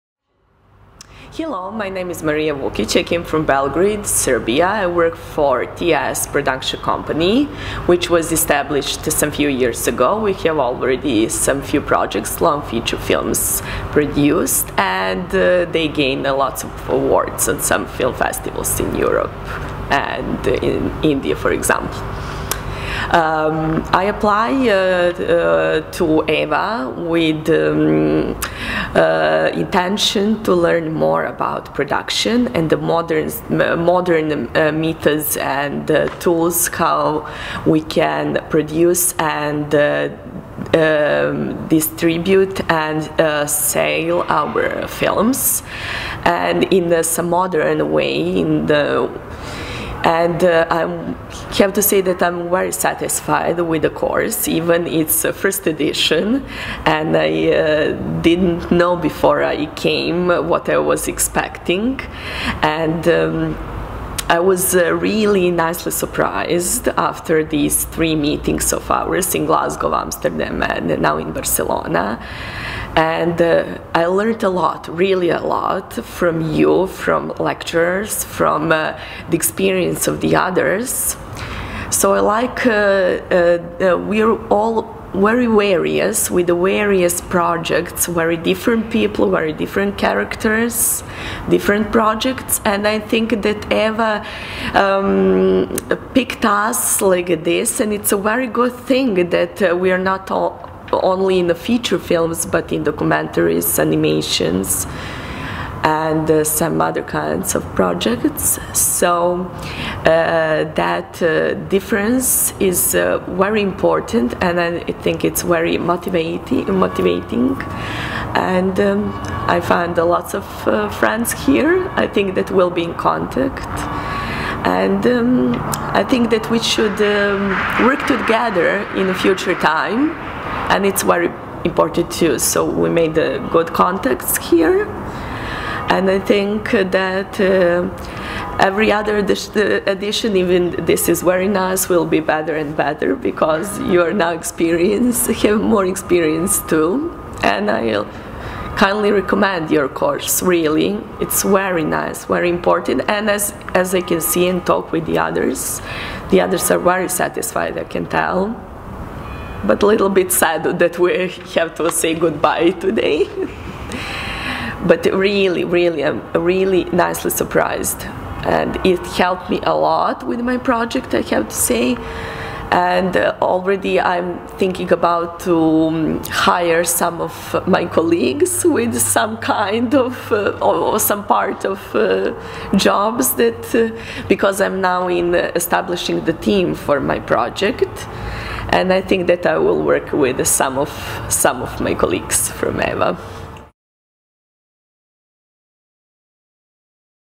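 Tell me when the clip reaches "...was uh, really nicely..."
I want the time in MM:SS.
01:04.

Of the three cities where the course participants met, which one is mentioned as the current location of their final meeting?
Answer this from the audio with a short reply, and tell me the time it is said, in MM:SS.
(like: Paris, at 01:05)
Barcelona, at 01:11.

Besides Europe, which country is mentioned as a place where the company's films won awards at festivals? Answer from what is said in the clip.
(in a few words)
India.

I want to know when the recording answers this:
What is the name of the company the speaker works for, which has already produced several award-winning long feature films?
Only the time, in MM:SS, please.
00:05.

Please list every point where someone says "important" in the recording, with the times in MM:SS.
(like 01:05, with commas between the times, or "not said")
01:53, 02:11, 02:32.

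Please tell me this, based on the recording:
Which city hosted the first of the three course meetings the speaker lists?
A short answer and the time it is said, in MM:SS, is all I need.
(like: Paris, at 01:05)
Glasgow, at 01:09.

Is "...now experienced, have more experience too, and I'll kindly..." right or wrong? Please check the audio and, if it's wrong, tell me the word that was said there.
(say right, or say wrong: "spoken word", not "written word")
right.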